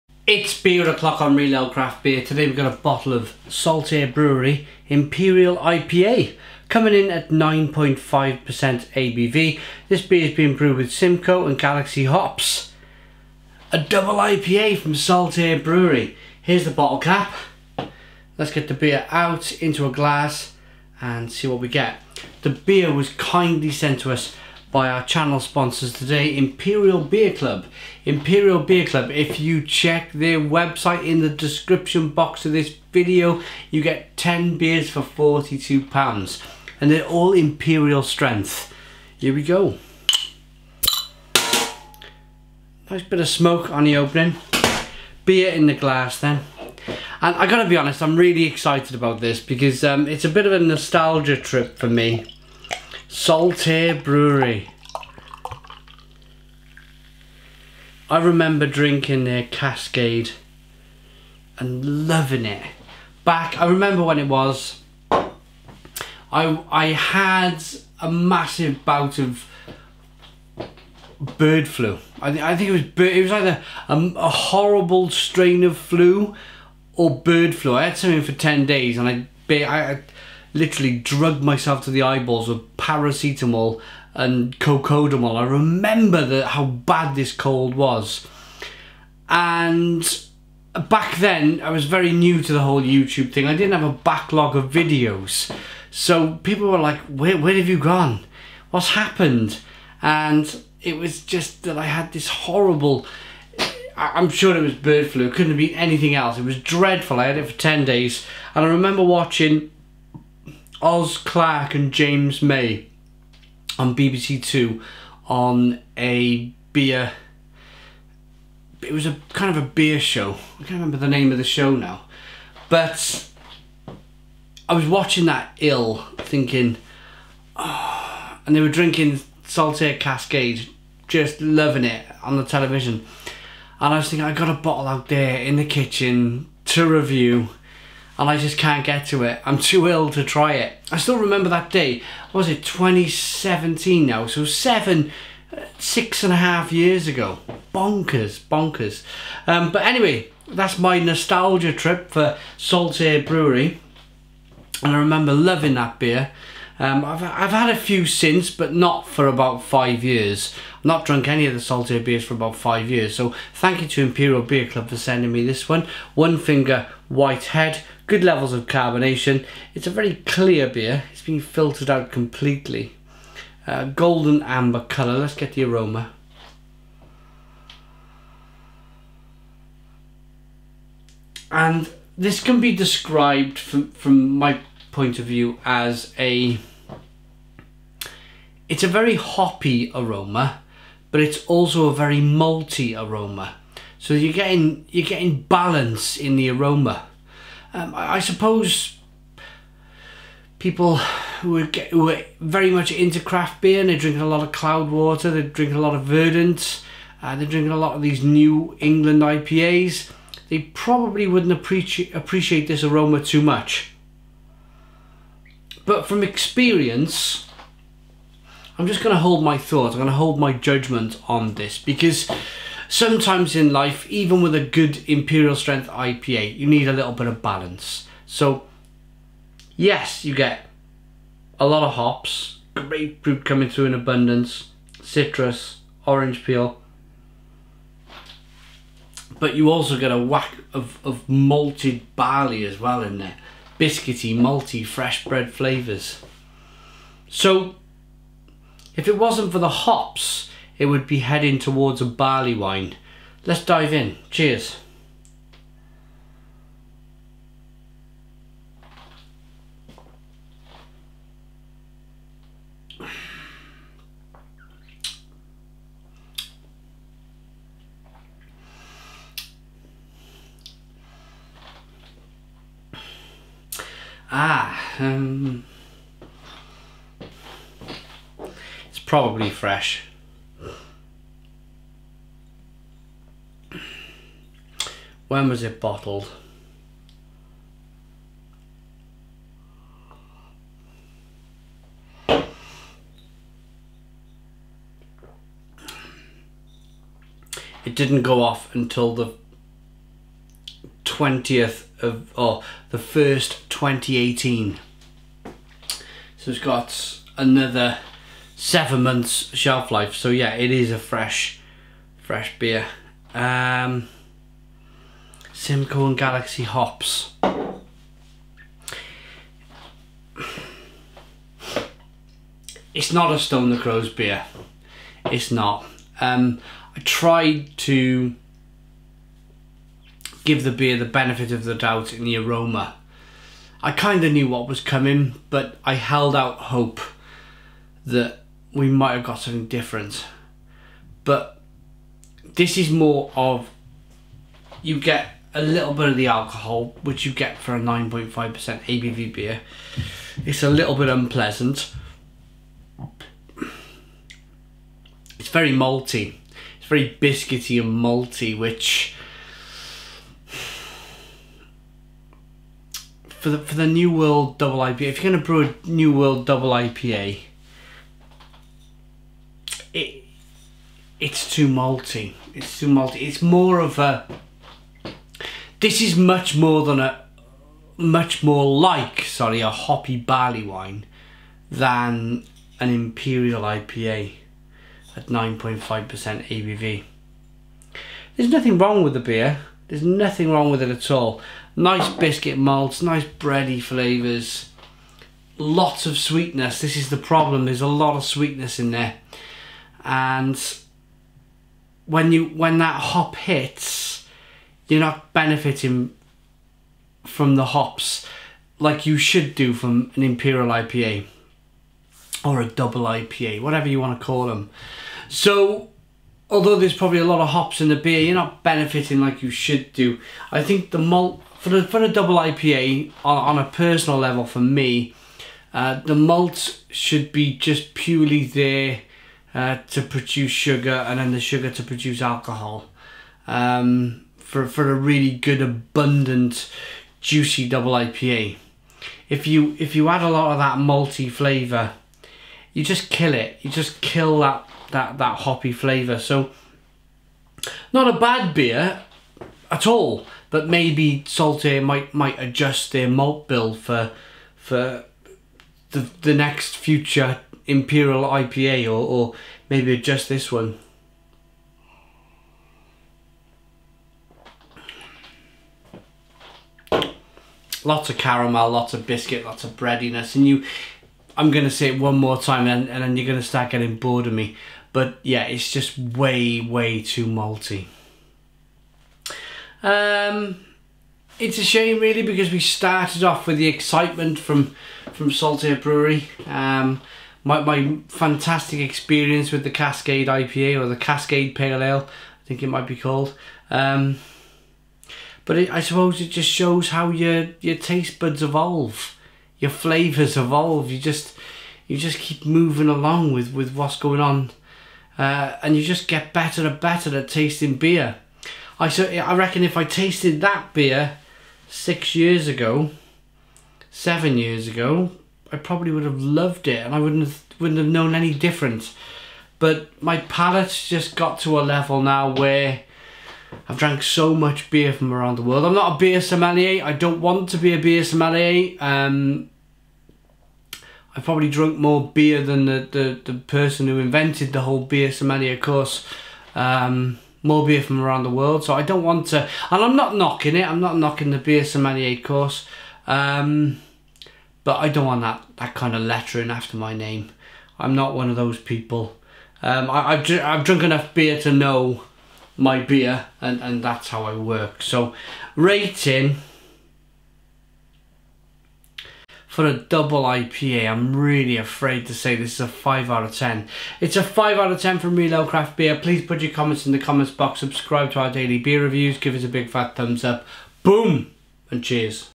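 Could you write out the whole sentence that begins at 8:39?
But my palate's just got to a level now where I've drank so much beer from around the world.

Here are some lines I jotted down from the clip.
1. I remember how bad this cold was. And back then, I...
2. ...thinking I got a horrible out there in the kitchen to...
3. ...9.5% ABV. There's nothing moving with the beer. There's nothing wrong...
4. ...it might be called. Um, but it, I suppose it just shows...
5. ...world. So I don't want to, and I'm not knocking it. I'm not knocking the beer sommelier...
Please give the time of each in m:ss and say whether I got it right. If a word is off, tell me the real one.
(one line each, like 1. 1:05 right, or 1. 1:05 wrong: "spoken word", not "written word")
1. 1:25 right
2. 2:14 wrong: "bottle", not "horrible"
3. 6:25 wrong: "wrong", not "moving"
4. 8:12 right
5. 8:58 right.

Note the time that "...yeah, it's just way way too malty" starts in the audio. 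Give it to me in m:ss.
7:55.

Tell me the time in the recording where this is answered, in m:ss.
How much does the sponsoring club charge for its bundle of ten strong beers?
0:35.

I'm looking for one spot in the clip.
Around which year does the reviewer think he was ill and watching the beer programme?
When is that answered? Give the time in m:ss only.
2:22.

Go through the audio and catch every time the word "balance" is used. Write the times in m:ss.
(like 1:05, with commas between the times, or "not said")
3:15, 3:47.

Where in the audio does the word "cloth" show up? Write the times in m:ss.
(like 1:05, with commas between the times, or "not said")
not said.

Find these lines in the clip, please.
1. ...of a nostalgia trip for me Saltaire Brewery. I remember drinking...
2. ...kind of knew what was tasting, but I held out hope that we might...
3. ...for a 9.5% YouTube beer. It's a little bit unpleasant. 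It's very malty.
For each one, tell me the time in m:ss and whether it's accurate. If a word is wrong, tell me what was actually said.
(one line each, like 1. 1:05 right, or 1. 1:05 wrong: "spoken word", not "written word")
1. 0:50 right
2. 5:33 wrong: "coming", not "tasting"
3. 5:47 wrong: "ABV", not "YouTube".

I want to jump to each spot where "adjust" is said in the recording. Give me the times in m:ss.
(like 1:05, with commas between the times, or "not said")
7:32, 7:39.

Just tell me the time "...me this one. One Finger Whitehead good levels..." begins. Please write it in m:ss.
2:45.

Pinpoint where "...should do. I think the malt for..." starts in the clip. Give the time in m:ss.
6:59.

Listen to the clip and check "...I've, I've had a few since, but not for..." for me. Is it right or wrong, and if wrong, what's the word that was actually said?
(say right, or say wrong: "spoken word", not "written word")
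right.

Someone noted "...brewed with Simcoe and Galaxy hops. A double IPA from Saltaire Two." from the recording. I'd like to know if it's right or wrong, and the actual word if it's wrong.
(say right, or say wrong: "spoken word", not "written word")
wrong: "Brewery", not "Two".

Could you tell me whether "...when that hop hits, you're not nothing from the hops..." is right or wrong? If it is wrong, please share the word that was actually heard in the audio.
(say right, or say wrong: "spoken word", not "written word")
wrong: "benefiting", not "nothing".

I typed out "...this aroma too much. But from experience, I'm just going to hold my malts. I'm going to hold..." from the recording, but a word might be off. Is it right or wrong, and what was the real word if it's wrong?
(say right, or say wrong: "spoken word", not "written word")
wrong: "thoughts", not "malts".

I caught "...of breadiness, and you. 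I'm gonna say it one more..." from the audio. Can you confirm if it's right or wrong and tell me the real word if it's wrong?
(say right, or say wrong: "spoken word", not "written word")
right.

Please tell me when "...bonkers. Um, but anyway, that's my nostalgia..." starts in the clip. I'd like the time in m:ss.
2:28.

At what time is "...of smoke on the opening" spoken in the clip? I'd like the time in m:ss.
0:43.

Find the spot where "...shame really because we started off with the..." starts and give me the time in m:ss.
8:01.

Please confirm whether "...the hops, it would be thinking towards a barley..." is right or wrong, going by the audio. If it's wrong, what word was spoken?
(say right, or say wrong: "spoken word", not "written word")
wrong: "heading", not "thinking".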